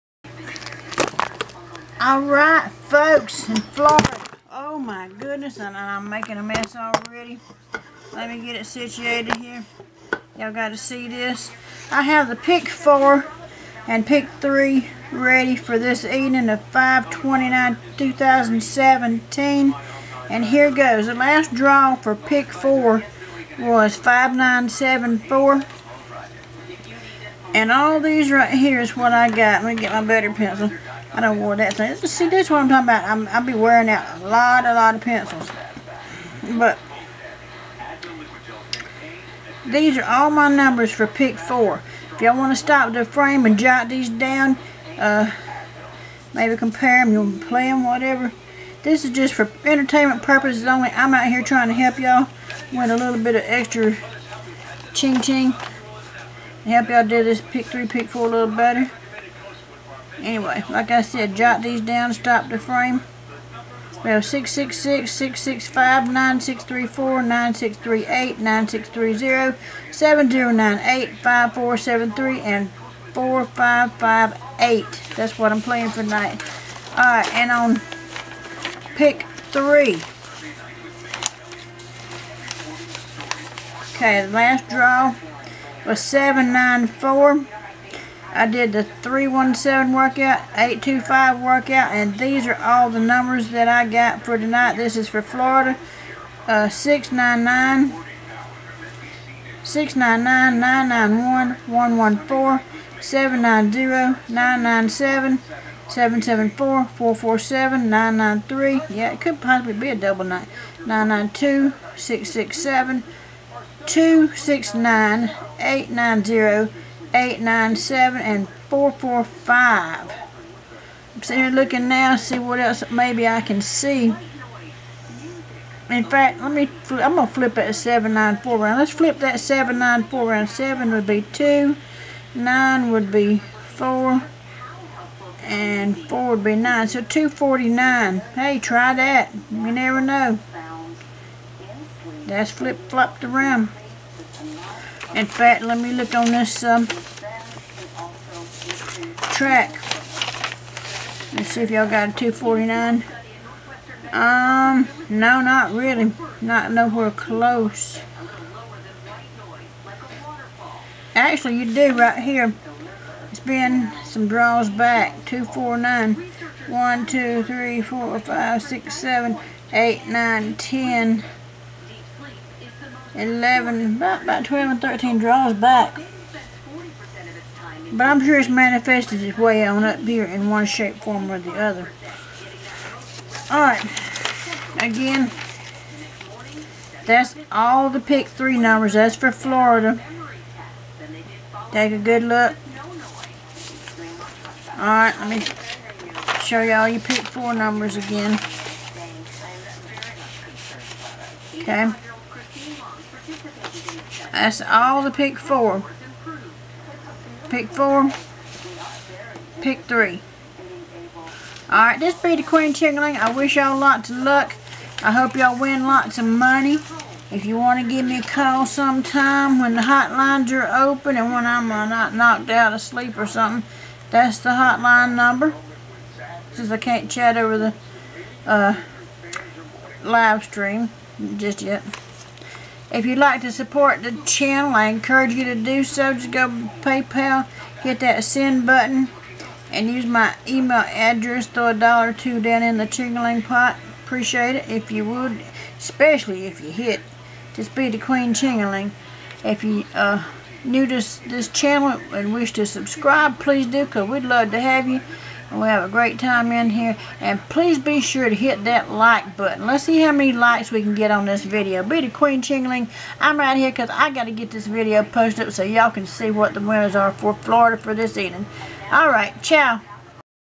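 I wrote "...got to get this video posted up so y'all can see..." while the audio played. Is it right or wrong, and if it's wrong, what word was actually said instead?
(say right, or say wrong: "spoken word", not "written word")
right.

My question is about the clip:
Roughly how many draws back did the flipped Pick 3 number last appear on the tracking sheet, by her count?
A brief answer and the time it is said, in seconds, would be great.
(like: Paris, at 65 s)
12 or 13, at 174 s.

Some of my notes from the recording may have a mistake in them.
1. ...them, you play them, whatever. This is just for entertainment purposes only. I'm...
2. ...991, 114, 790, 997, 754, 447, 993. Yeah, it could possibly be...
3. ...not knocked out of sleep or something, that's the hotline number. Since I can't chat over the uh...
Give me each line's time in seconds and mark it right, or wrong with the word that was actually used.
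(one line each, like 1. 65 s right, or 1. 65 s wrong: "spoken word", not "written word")
1. 47 s right
2. 100 s wrong: "774", not "754"
3. 221 s right.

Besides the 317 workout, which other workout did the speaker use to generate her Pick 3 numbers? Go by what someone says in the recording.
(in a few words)
825.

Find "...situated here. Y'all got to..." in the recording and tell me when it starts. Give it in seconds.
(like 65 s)
8 s.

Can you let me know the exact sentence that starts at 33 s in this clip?
I'm, I'll be wearing out a lot, a lot of pencils.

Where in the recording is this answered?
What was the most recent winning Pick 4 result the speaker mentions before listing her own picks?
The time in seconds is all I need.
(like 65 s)
23 s.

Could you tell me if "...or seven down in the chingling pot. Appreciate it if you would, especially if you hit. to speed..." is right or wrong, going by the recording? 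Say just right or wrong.
wrong.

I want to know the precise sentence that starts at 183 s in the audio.
Alright, again, that's all the pick three numbers.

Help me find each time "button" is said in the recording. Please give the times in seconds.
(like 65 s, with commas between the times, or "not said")
238 s, 259 s.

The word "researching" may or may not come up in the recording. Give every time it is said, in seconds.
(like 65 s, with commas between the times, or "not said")
not said.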